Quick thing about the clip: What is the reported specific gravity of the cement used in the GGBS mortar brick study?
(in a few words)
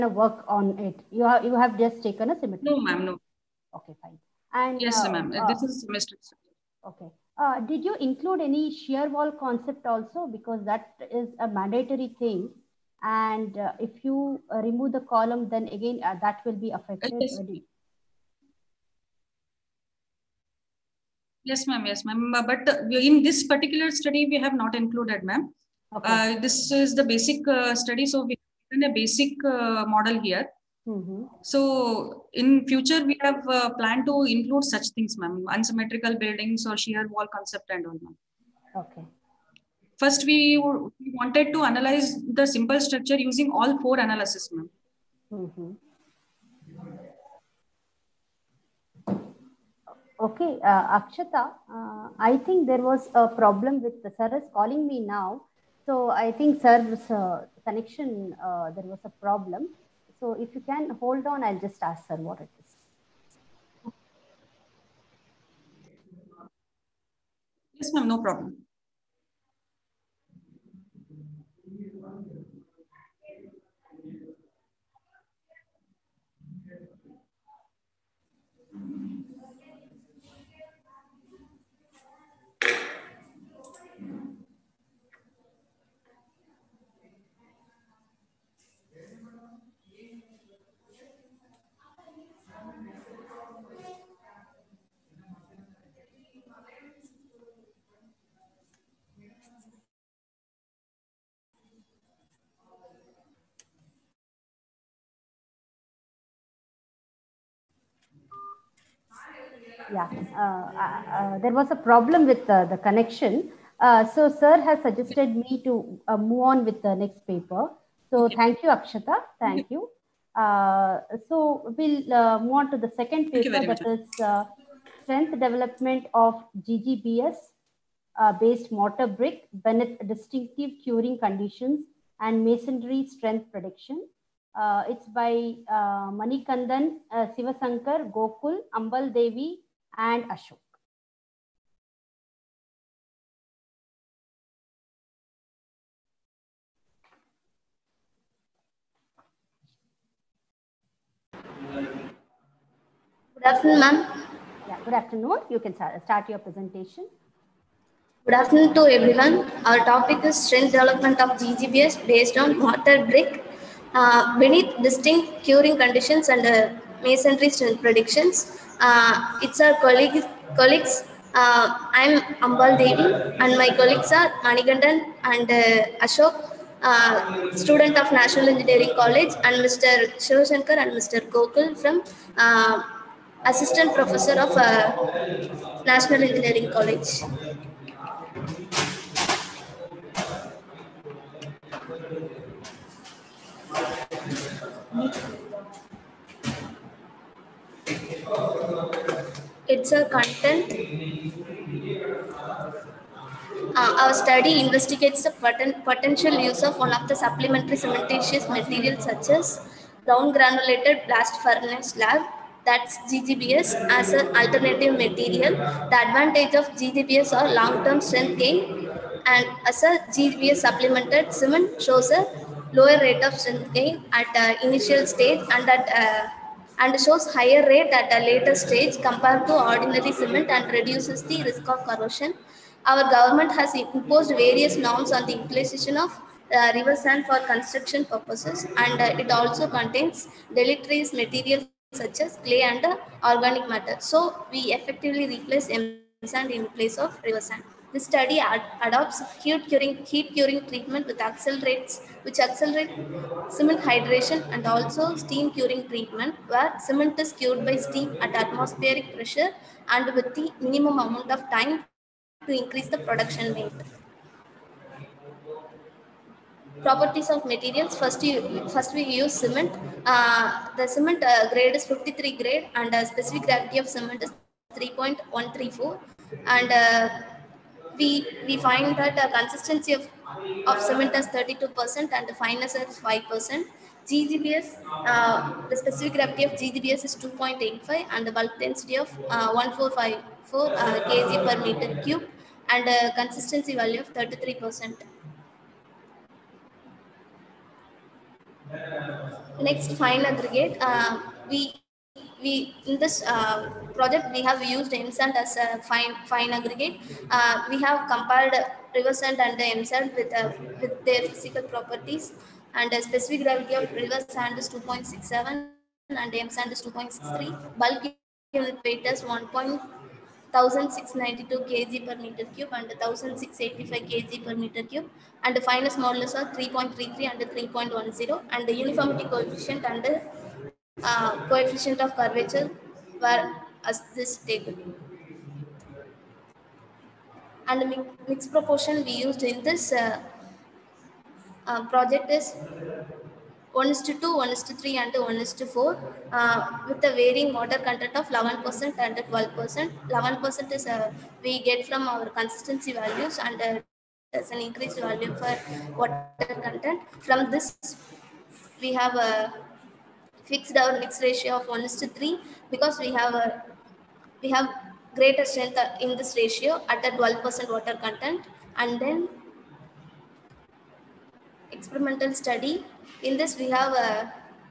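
3.134.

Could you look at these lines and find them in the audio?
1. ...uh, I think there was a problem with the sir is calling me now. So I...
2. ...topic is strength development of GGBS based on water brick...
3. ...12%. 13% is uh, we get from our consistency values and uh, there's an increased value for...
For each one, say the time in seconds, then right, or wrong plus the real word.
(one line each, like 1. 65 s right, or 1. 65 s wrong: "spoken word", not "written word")
1. 51 s right
2. 159 s right
3. 349 s wrong: "11", not "13".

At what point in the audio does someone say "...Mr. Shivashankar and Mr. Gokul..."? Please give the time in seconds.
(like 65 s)
179 s.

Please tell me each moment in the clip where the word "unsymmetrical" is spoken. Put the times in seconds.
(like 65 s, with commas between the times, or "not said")
35 s.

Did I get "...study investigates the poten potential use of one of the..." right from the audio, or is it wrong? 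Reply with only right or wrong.
right.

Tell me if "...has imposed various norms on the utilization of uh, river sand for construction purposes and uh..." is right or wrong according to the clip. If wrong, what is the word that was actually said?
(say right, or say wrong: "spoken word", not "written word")
right.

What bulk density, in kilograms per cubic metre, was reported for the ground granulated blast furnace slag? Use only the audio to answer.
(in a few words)
1454.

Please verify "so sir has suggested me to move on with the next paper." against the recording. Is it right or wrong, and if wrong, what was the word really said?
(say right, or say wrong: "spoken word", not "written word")
right.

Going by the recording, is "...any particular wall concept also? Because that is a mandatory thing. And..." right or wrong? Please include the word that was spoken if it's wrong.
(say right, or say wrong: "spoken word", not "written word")
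wrong: "shear", not "particular".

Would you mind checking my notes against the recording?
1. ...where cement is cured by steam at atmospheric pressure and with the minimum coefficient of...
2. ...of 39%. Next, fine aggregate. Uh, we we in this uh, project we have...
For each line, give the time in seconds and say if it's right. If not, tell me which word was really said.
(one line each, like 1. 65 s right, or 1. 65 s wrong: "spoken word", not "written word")
1. 256 s wrong: "amount", not "coefficient"
2. 294 s wrong: "33", not "39".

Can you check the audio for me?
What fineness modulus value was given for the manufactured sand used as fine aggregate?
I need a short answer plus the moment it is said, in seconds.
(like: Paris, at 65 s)
3.10, at 327 s.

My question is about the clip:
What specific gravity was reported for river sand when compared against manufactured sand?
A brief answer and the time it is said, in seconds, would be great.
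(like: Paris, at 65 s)
2.67, at 314 s.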